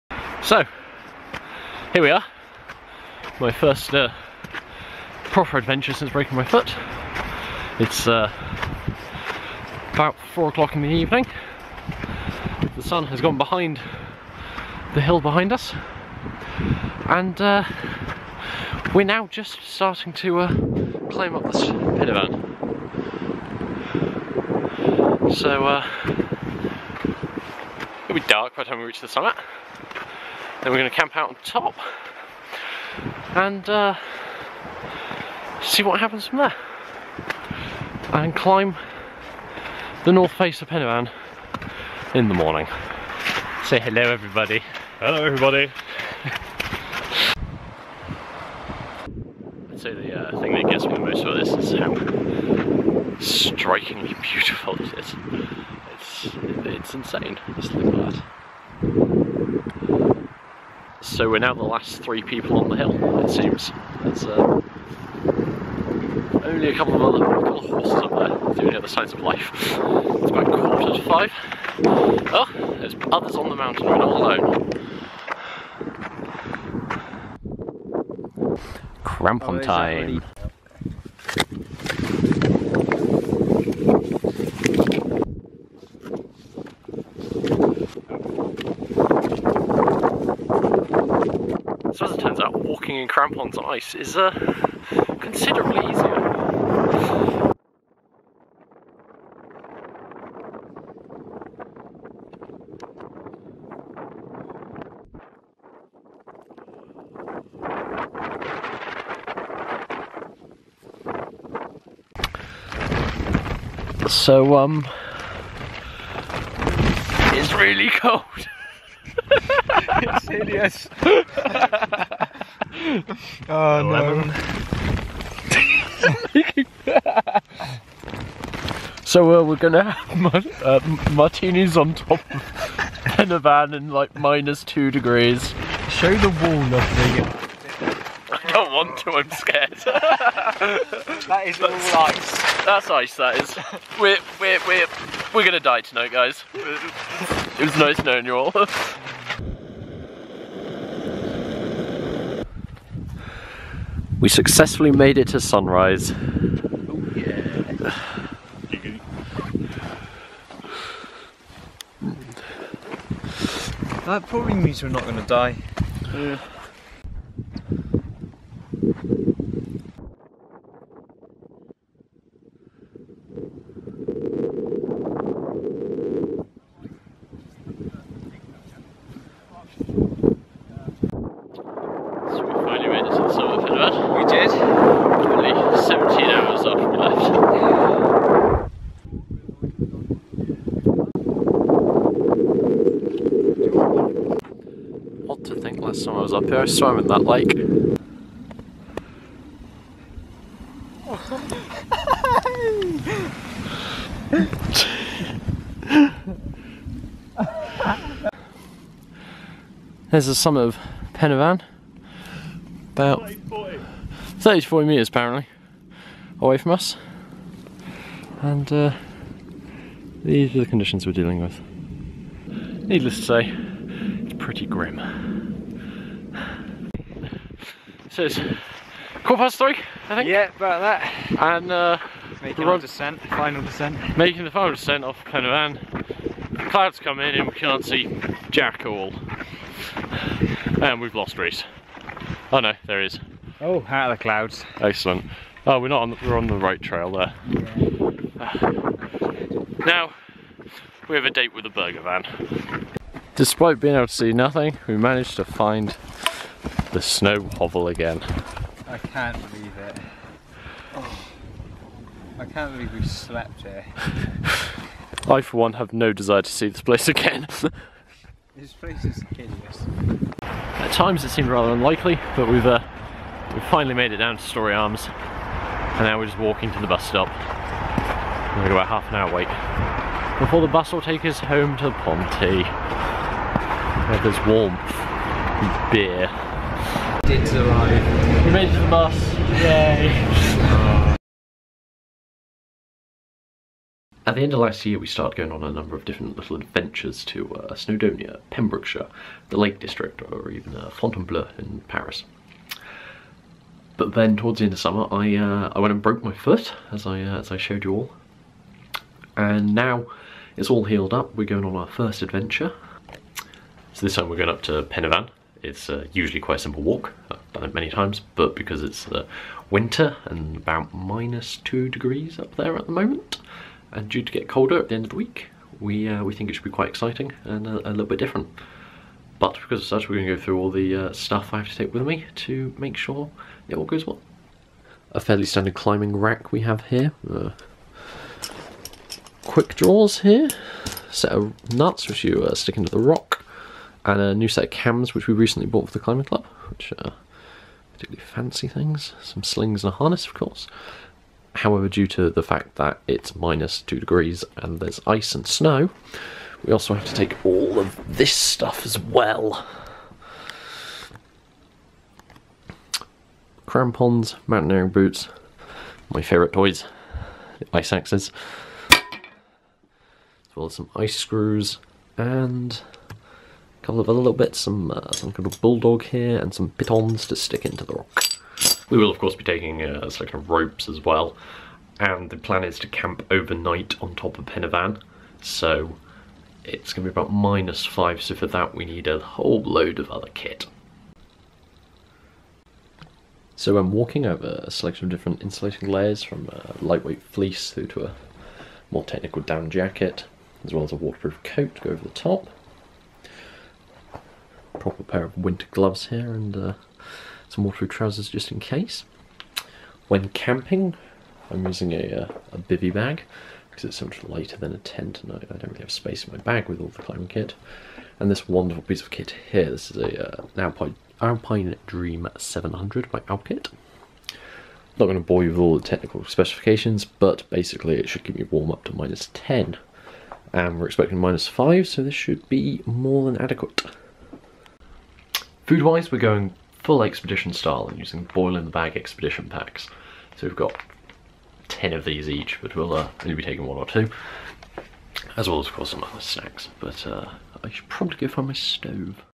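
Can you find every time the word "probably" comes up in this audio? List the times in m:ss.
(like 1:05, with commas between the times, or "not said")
2:44, 7:27.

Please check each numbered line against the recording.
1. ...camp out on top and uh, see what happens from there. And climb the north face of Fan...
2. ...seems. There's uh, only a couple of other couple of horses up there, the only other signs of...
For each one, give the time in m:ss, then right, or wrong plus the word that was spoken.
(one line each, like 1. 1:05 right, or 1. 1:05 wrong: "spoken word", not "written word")
1. 0:30 wrong: "Pen", not "Fan"
2. 1:03 right.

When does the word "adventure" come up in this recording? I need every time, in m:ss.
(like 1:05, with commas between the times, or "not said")
0:05, 4:56, 5:12.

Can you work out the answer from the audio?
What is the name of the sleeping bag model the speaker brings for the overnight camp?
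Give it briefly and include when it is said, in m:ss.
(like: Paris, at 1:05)
Alpine Dream 700, at 7:01.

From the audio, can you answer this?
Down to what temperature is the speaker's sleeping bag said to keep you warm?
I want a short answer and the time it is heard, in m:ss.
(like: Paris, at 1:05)
Minus 10, at 7:08.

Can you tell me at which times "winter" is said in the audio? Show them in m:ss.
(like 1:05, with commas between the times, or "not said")
5:19, 6:45.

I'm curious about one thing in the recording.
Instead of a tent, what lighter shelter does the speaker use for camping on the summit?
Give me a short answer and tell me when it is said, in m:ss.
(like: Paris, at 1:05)
Bivy bag, at 6:52.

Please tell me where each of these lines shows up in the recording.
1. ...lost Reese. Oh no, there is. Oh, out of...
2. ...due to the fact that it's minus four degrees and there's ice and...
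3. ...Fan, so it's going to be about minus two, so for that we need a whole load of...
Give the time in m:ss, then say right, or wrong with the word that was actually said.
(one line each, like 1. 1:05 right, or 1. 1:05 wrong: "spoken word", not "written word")
1. 4:01 right
2. 5:51 wrong: "two", not "four"
3. 6:24 wrong: "five", not "two".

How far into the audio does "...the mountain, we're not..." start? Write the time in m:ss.
1:13.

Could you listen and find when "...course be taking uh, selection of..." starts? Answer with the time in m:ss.
6:19.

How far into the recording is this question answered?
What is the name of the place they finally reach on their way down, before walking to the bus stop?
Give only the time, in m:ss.
4:34.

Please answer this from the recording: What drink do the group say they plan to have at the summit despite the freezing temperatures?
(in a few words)
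Martinis.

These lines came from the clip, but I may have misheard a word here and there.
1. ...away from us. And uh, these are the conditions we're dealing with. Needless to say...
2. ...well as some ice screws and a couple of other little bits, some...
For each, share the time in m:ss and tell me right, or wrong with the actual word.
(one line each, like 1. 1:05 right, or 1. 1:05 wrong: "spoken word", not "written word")
1. 3:36 right
2. 6:10 right.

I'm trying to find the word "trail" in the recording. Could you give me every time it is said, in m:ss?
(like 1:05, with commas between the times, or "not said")
4:06.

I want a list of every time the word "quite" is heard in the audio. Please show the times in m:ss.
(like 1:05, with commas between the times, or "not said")
5:16, 5:26.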